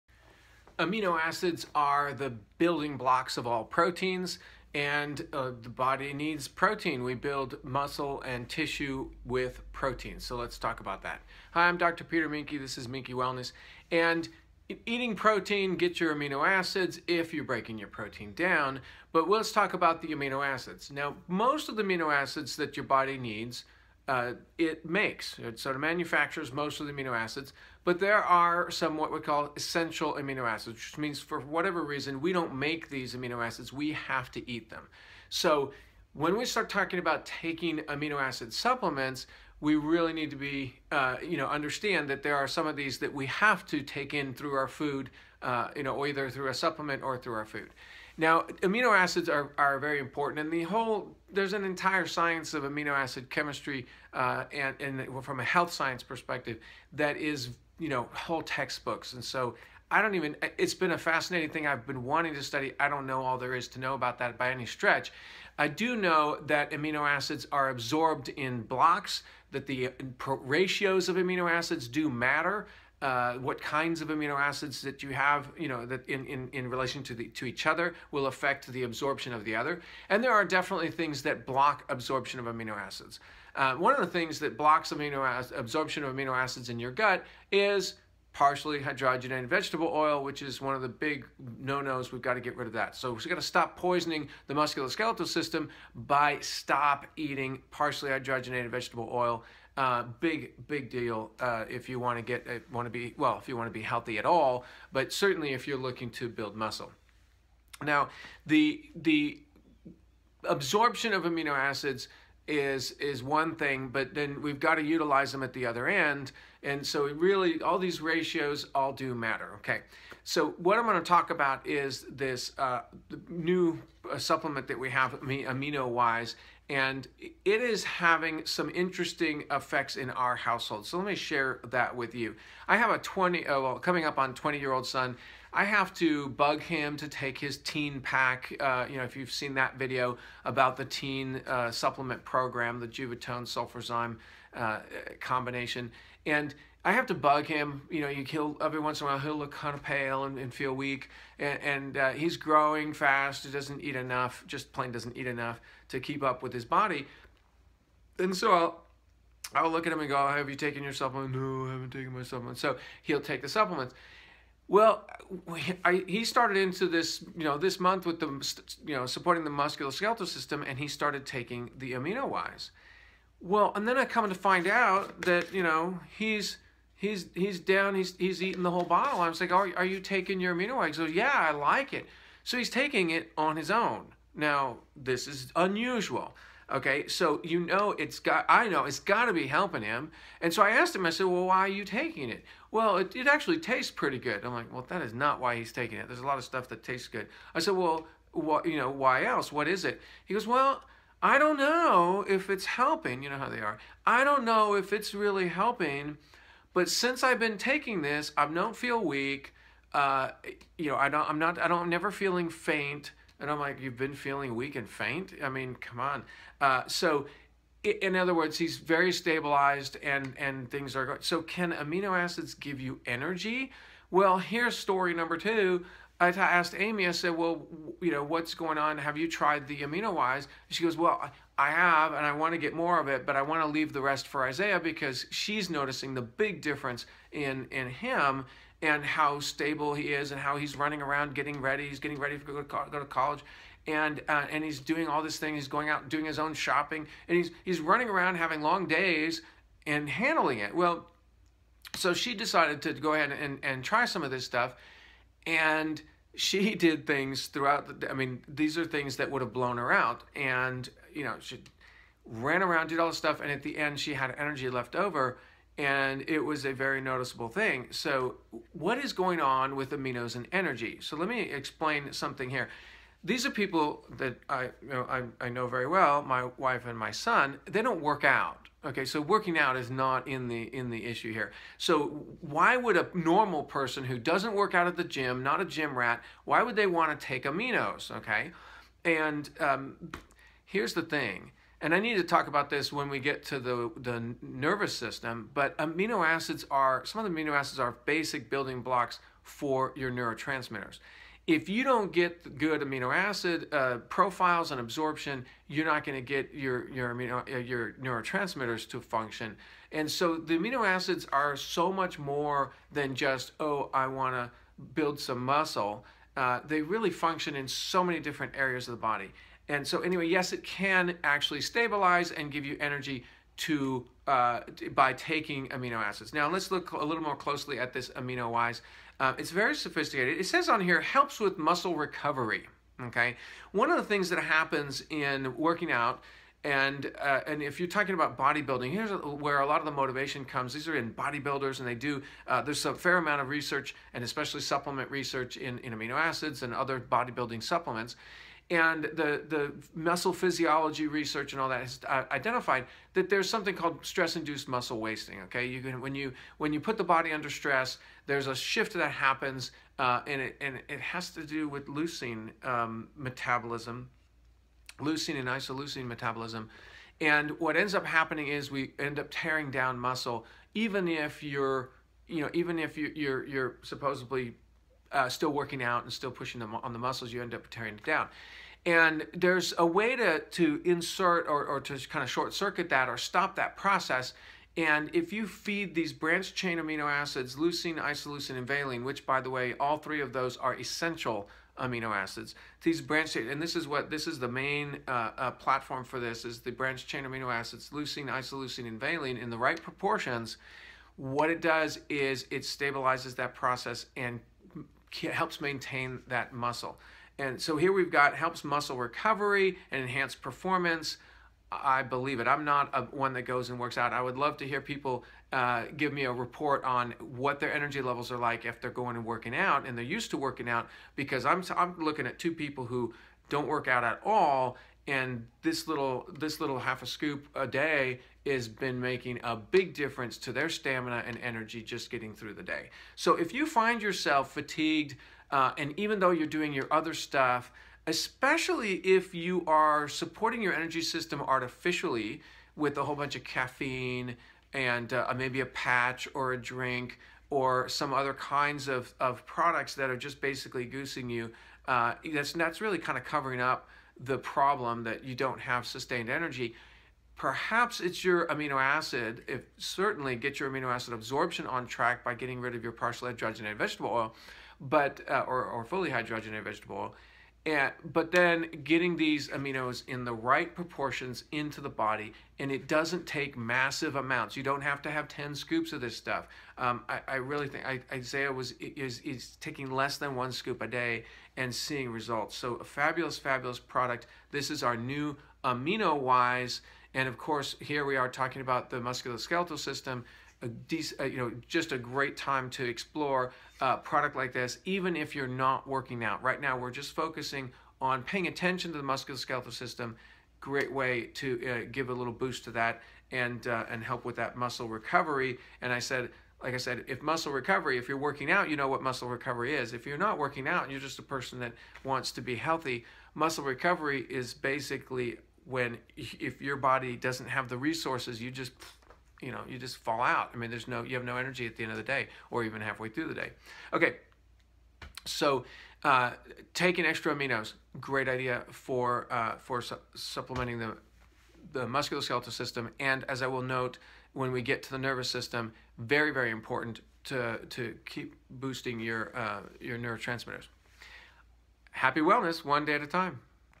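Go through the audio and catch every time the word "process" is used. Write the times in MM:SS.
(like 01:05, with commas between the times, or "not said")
06:23, 06:43.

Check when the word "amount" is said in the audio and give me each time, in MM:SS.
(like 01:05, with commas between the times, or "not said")
05:43, 07:54.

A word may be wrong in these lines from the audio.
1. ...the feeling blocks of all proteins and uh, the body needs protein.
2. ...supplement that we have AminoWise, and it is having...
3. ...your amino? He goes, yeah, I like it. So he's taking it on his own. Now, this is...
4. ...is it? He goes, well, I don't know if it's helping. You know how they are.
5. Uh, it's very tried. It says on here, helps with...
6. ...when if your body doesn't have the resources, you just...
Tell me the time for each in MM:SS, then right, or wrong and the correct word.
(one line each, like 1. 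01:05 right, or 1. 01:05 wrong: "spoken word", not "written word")
1. 00:02 wrong: "building", not "feeling"
2. 02:04 right
3. 03:00 right
4. 03:19 right
5. 05:29 wrong: "sophisticated", not "tried"
6. 08:35 right.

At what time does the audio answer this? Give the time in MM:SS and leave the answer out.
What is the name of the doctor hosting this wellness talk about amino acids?
00:11.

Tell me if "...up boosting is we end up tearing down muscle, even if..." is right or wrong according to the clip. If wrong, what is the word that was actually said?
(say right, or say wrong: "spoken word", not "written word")
wrong: "happening", not "boosting".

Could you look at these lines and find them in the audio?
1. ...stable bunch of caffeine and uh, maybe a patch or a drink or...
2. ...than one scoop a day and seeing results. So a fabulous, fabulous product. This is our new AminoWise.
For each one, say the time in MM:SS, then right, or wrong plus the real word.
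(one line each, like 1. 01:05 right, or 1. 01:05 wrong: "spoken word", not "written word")
1. 07:23 wrong: "whole", not "stable"
2. 08:00 right.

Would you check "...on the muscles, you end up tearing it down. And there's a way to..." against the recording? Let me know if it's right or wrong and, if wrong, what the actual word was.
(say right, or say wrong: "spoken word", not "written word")
right.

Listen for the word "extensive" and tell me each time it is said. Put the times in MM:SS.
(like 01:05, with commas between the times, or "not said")
not said.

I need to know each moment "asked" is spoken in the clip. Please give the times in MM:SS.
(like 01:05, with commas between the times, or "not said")
03:10, 03:46.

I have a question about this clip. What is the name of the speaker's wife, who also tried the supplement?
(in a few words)
Amy.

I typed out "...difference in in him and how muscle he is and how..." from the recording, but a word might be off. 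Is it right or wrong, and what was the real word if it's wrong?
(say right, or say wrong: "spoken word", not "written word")
wrong: "stable", not "muscle".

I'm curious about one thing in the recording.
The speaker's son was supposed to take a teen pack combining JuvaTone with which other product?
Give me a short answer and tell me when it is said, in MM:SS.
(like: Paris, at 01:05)
Sulfurzyme, at 02:23.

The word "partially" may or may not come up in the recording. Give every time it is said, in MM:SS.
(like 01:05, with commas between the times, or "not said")
01:28, 01:37, 07:42.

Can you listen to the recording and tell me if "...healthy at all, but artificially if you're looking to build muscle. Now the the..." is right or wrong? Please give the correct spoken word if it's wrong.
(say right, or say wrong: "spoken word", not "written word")
wrong: "certainly", not "artificially".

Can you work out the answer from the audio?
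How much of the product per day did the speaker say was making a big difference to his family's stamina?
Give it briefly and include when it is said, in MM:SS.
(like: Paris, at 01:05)
half a scoop, at 07:06.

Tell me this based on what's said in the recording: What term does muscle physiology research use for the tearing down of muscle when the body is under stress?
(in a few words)
stress-induced muscle wasting.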